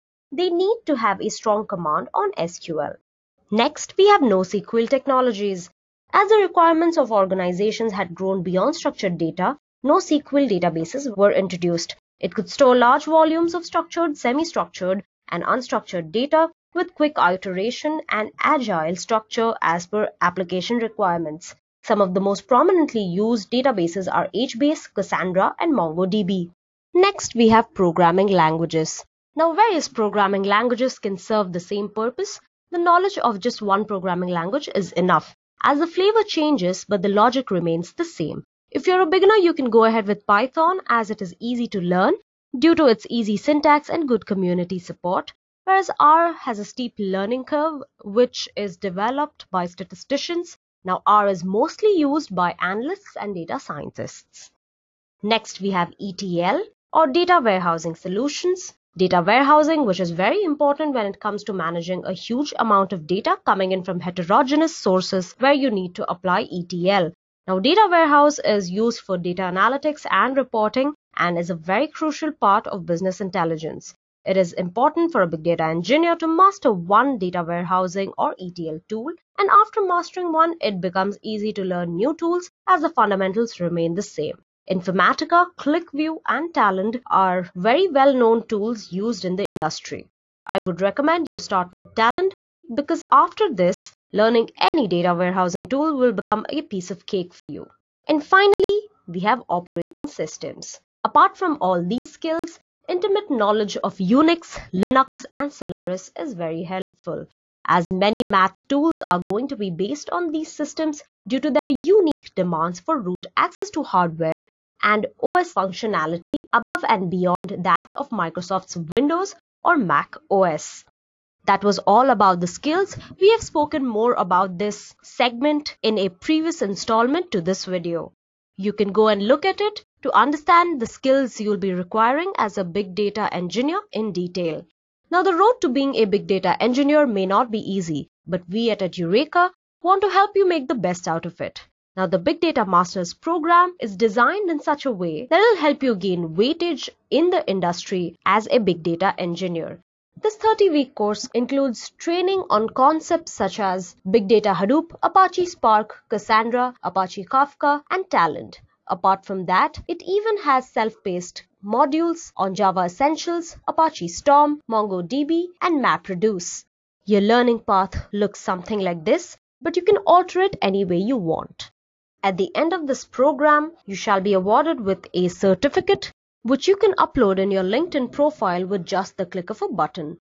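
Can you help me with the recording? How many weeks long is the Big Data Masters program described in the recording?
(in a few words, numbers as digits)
30 weeks.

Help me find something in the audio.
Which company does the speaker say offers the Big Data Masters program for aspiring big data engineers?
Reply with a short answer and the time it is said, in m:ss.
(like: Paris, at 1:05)
Edureka, at 2:18.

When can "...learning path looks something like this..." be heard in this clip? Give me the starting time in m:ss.
2:47.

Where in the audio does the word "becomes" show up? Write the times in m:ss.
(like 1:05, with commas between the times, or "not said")
1:20, 1:36.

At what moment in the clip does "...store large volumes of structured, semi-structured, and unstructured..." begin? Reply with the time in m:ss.
0:12.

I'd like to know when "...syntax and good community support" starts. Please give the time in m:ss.
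0:43.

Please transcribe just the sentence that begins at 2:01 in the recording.
That was all about the skills.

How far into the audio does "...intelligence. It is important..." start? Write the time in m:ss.
1:13.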